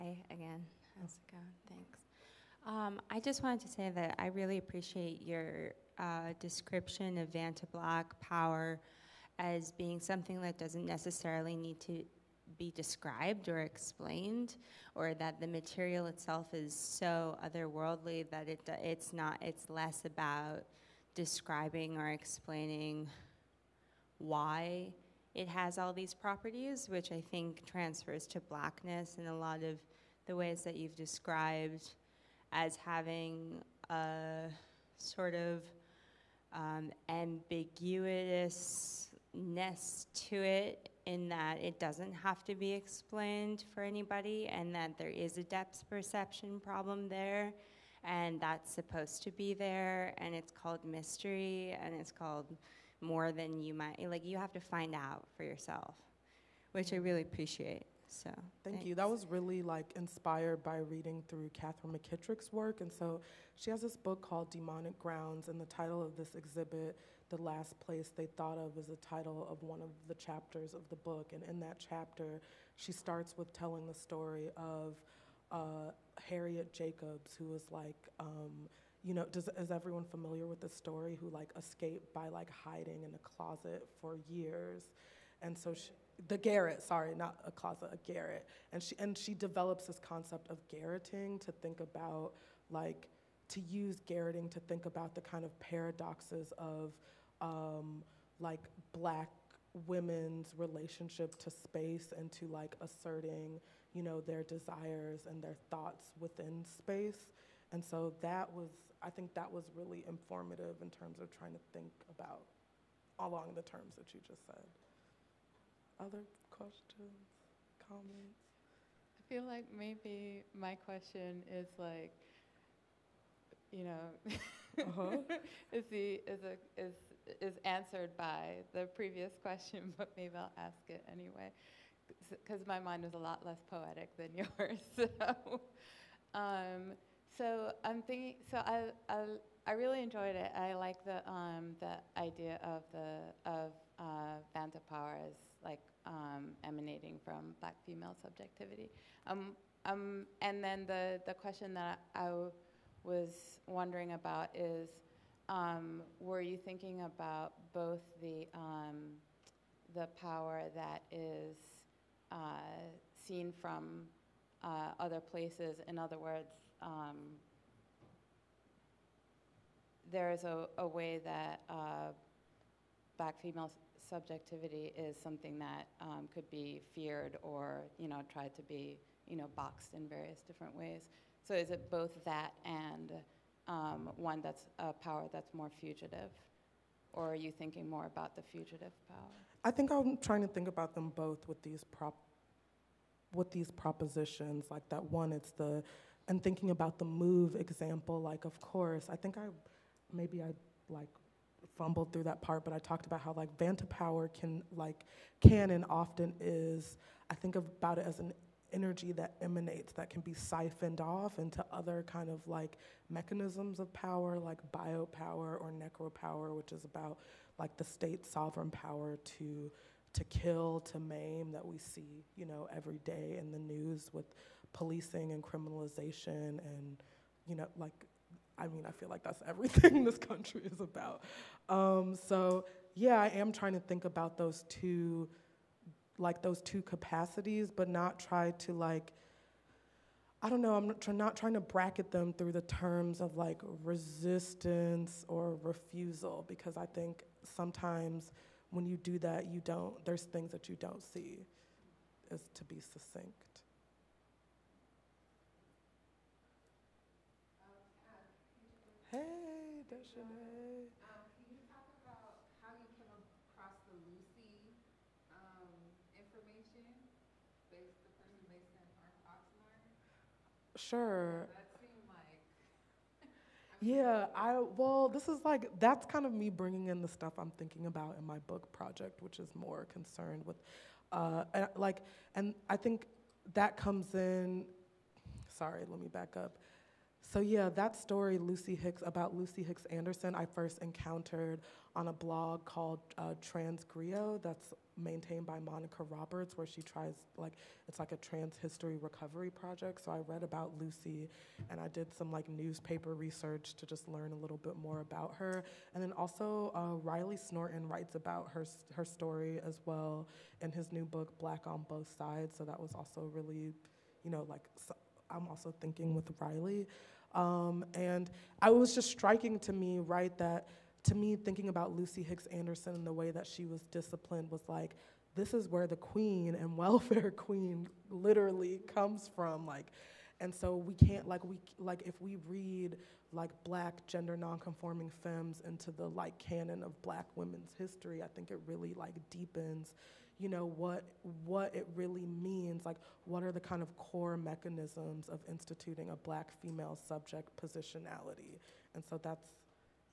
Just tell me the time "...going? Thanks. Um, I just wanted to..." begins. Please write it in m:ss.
0:01.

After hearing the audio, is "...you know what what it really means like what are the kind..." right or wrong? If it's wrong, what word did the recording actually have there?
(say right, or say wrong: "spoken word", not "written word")
right.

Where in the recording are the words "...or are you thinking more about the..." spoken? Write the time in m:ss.
3:07.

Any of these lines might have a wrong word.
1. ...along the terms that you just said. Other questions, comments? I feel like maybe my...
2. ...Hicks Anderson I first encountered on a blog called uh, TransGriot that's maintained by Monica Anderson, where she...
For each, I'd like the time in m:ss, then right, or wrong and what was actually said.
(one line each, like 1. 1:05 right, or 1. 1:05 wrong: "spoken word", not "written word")
1. 1:53 right
2. 4:49 wrong: "Roberts", not "Anderson".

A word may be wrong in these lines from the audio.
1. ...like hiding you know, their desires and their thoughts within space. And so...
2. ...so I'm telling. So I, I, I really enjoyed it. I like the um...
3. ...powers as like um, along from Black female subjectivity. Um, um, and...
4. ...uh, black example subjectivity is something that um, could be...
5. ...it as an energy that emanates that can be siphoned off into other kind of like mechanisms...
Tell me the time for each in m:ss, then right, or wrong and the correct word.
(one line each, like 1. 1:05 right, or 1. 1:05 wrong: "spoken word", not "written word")
1. 1:42 wrong: "asserting", not "hiding"
2. 2:17 wrong: "thinking", not "telling"
3. 2:24 wrong: "emanating", not "along"
4. 2:51 wrong: "female", not "example"
5. 3:27 right.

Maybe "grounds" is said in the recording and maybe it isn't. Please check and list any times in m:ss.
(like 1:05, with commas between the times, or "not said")
1:04.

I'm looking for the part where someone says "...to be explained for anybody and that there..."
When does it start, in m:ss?
0:42.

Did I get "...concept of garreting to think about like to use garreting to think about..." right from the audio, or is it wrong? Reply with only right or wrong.
right.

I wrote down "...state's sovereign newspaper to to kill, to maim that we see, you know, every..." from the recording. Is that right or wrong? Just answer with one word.
wrong.